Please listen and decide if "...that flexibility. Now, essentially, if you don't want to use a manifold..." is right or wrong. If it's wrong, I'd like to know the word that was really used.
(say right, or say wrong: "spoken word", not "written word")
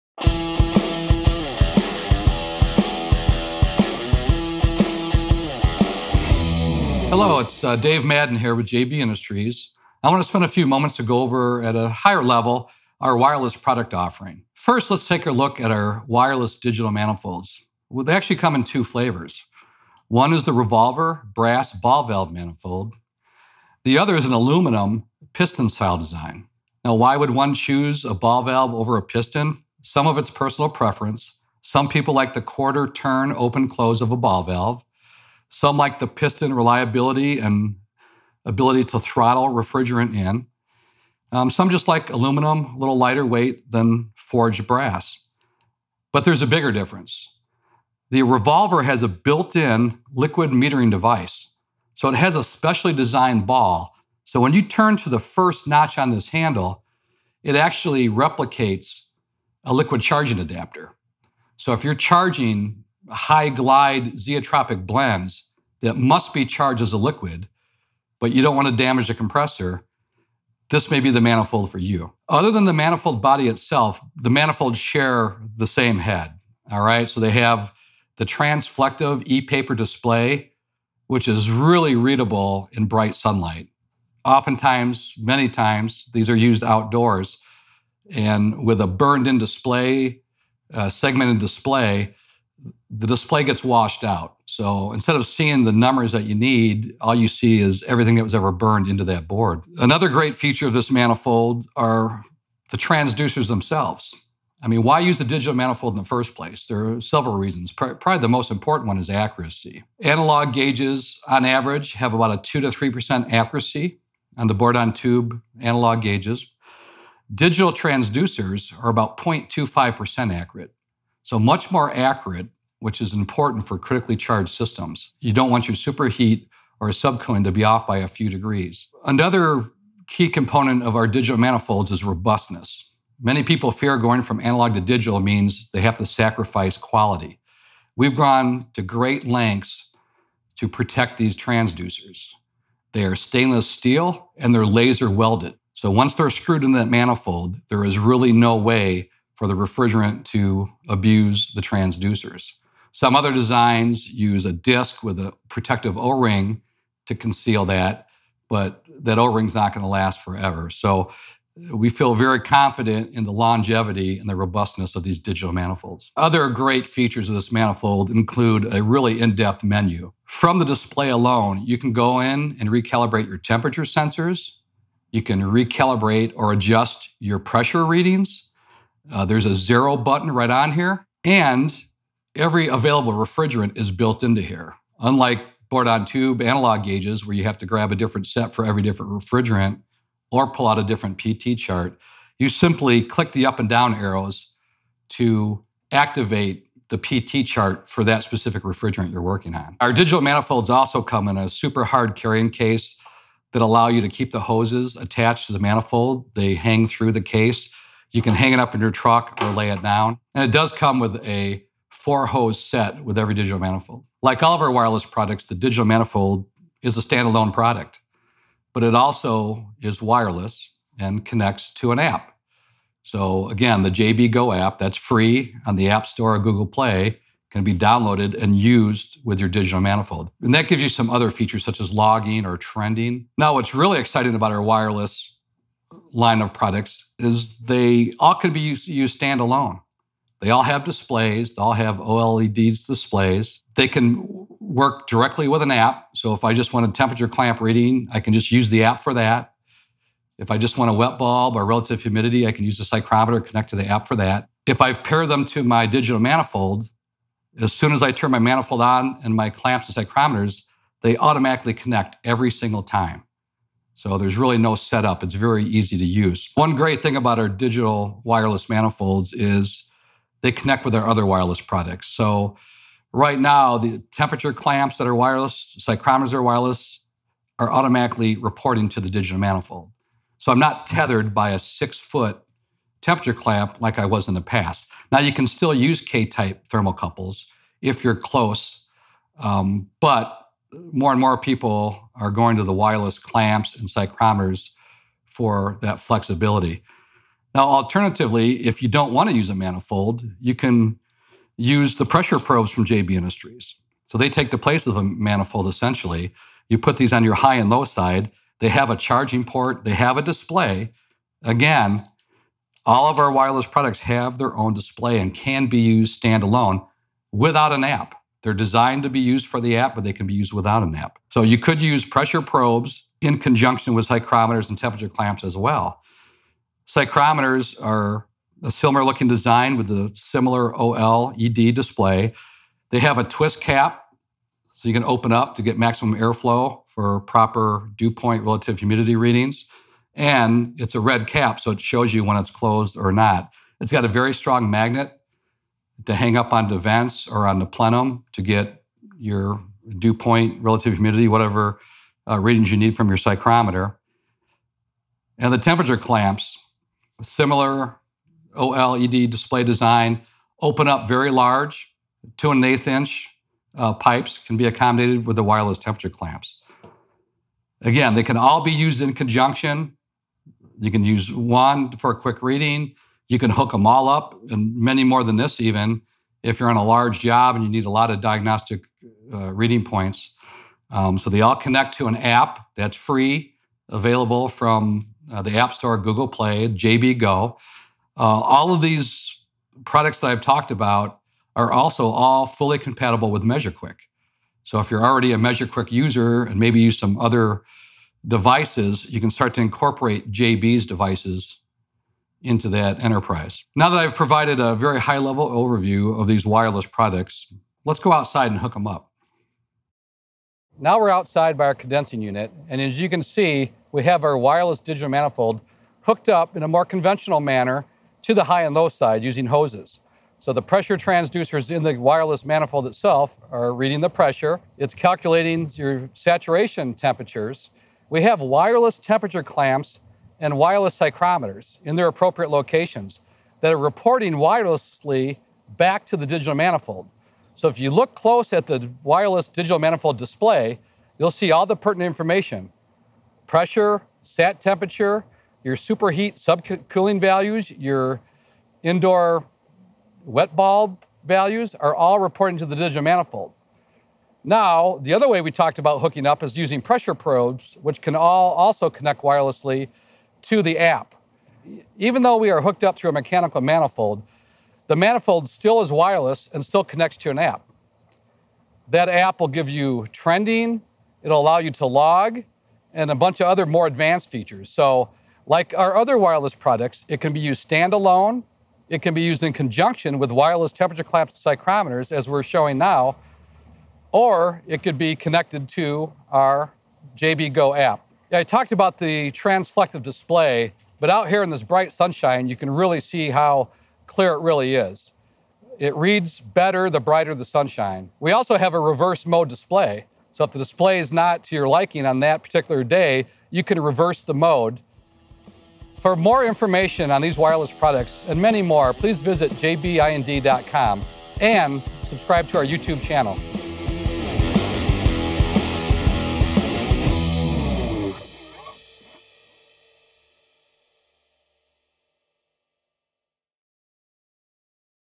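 wrong: "alternatively", not "essentially".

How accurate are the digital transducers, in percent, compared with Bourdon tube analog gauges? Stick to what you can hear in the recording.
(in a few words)
0.25%.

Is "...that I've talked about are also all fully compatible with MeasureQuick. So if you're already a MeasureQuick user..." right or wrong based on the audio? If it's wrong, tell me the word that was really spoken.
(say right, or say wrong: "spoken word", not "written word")
right.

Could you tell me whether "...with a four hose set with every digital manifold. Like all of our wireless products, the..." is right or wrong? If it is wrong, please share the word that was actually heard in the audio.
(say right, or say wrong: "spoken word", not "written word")
right.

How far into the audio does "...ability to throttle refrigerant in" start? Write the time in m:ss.
0:38.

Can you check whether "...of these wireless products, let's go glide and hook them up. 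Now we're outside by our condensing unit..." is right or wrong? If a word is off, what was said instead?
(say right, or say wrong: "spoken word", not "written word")
wrong: "outside", not "glide".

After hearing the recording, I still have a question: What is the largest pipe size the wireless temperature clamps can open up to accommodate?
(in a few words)
2 1/8 inch.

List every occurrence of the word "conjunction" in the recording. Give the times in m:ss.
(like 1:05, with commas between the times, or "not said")
5:23, 6:09, 7:59.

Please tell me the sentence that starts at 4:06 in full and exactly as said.
So if I just want a temperature clamp reading, I can just use the app for that.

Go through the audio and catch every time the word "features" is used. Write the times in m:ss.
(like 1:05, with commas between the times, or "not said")
1:40, 2:46, 3:51, 7:54.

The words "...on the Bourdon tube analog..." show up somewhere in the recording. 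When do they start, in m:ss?
1:54.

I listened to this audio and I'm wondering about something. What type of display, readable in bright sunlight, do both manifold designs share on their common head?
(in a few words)
transflective e paper display.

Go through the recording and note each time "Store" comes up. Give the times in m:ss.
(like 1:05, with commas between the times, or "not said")
3:46, 6:25.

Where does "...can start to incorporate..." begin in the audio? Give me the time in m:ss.
6:39.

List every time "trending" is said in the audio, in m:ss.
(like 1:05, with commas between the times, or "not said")
3:52, 7:50.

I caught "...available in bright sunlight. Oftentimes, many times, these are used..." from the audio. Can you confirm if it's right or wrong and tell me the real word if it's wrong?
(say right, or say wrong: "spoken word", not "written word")
wrong: "readable", not "available".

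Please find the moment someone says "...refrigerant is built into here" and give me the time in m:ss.
3:03.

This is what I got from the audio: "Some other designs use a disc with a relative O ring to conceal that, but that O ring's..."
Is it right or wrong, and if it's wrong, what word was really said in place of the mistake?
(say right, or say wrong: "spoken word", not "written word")
wrong: "protective", not "relative".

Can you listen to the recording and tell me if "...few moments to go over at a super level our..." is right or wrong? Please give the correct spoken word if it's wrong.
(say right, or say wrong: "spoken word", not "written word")
wrong: "higher", not "super".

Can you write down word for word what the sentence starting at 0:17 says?
Well, they actually come in two flavors.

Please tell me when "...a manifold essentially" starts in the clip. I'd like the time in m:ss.
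5:04.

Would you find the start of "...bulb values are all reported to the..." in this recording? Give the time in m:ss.
7:30.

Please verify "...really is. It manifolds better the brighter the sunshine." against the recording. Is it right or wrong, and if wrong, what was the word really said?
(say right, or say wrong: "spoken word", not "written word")
wrong: "reads", not "manifolds".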